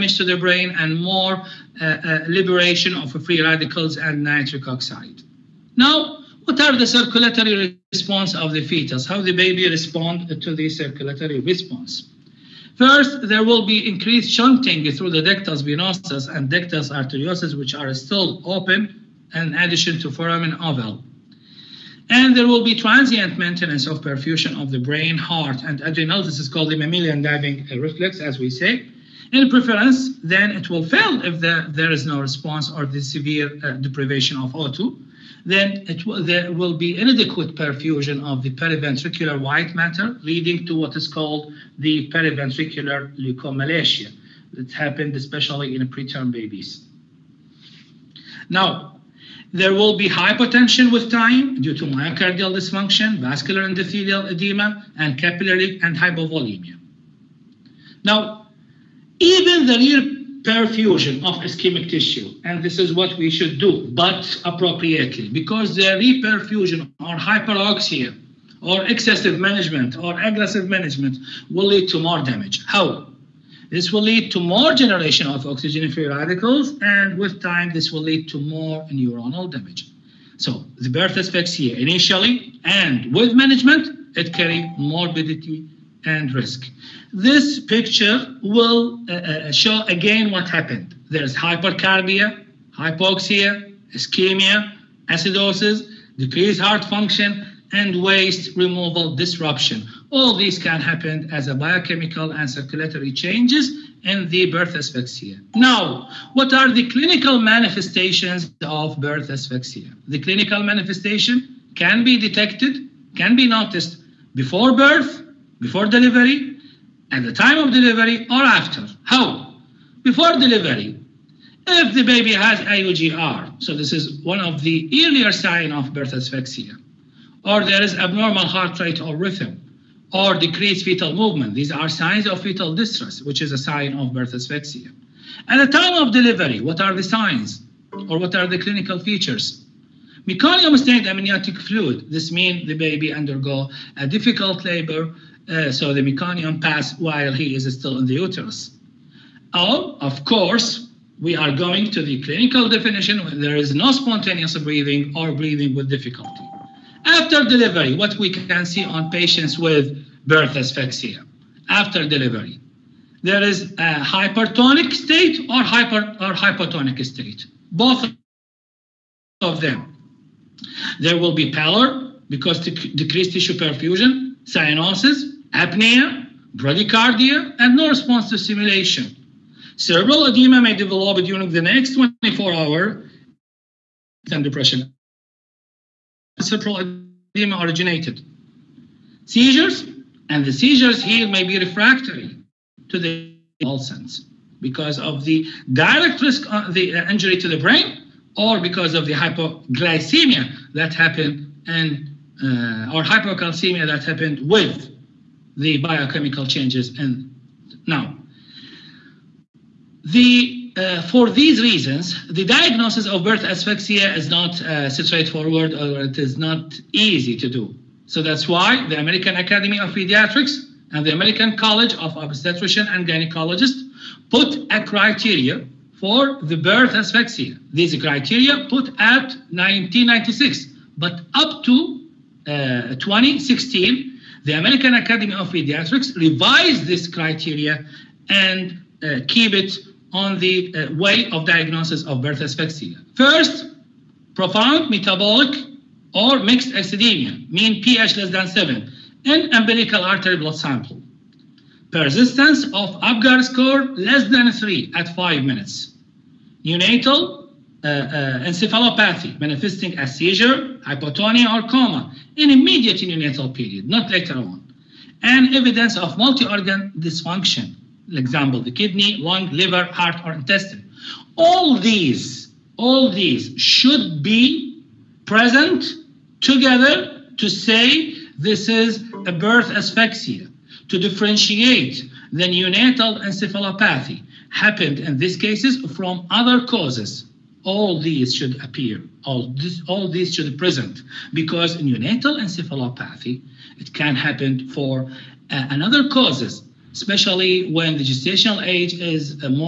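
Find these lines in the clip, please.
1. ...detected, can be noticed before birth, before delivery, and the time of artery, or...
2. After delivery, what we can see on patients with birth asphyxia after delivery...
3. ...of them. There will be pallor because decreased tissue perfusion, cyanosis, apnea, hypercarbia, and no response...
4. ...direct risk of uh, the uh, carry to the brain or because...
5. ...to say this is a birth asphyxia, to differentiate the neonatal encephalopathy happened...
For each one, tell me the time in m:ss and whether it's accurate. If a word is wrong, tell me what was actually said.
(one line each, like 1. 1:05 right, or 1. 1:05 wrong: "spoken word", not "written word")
1. 1:52 wrong: "delivery", not "artery"
2. 2:37 right
3. 2:49 wrong: "bradycardia", not "hypercarbia"
4. 3:15 wrong: "injury", not "carry"
5. 4:37 right.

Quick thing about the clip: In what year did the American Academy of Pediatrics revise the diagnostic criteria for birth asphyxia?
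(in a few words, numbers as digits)
2016.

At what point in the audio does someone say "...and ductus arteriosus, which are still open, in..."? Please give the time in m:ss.
0:16.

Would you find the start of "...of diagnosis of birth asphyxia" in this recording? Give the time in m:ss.
4:01.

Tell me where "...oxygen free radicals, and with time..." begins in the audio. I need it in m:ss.
1:15.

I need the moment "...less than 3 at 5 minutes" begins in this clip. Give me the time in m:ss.
4:13.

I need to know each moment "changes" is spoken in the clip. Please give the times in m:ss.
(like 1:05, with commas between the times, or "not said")
1:43, 3:26.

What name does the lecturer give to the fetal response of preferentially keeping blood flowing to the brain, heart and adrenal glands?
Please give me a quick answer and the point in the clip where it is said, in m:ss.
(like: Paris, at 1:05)
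mammalian diving reflex, at 0:26.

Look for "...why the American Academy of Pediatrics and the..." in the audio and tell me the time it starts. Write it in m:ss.
3:38.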